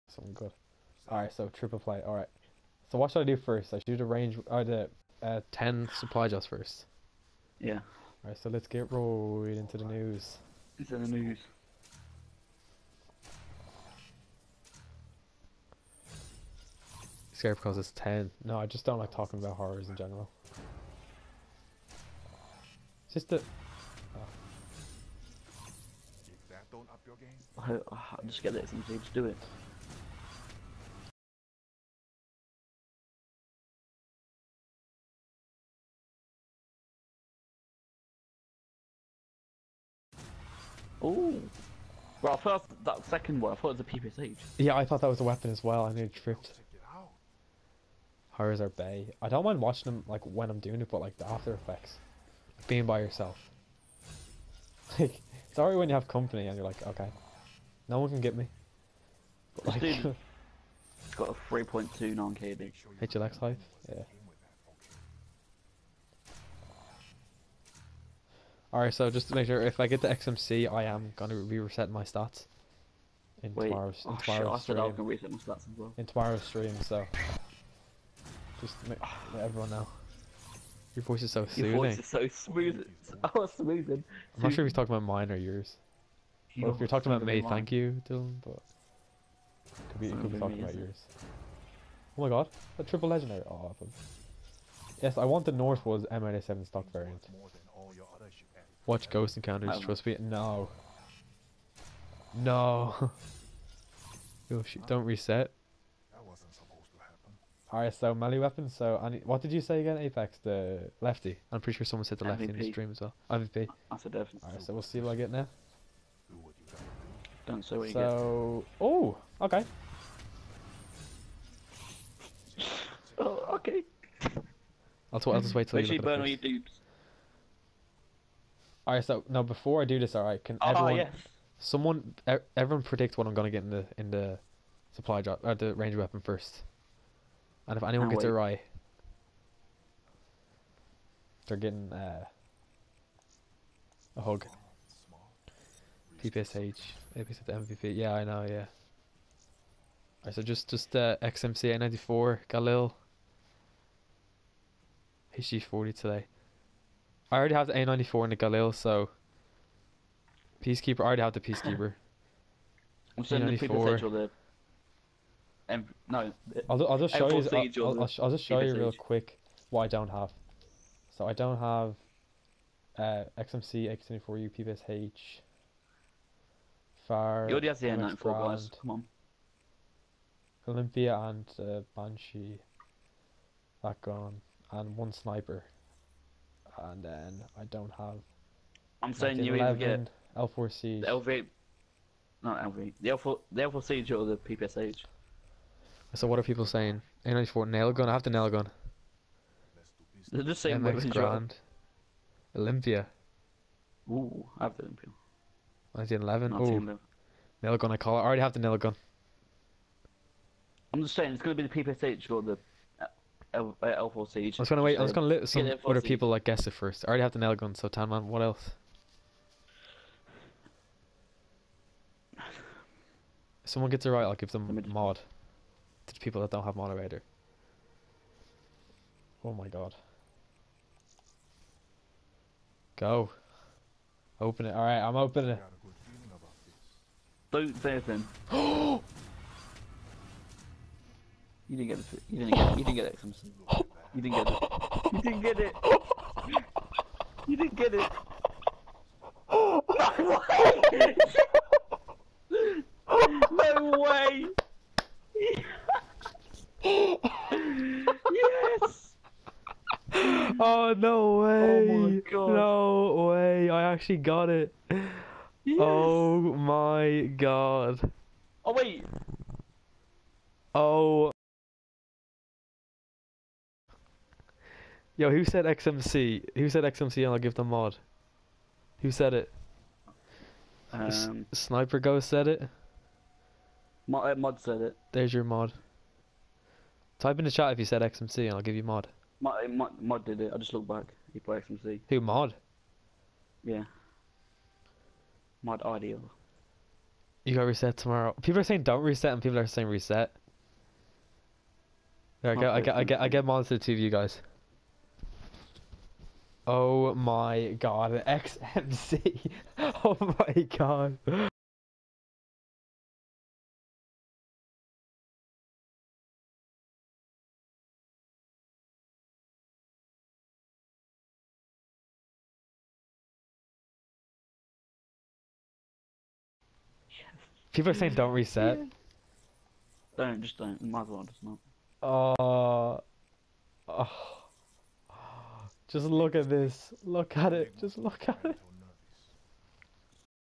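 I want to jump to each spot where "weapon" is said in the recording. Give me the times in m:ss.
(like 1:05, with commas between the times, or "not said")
0:45, 1:48, 2:15.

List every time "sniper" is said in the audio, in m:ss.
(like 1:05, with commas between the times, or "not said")
3:05, 4:41.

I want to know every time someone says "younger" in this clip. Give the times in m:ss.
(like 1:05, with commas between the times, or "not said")
not said.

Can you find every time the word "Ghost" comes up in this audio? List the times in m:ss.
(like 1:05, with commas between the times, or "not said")
1:39, 4:41.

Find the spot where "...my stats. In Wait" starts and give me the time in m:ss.
1:11.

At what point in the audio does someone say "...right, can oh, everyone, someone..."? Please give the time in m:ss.
2:10.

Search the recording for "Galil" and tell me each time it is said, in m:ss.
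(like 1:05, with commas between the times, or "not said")
2:32, 2:38.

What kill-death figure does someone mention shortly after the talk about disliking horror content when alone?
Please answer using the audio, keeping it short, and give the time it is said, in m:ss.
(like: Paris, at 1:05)
3.2, at 1:01.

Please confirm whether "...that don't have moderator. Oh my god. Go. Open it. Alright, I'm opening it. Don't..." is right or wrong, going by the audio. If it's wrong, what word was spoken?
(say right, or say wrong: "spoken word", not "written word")
right.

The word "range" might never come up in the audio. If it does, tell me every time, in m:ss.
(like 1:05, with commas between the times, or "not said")
0:04, 2:15.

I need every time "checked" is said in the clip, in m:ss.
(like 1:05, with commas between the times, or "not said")
not said.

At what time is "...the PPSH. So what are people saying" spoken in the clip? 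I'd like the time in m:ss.
3:14.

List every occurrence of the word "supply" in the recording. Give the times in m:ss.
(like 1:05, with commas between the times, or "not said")
0:05, 2:14.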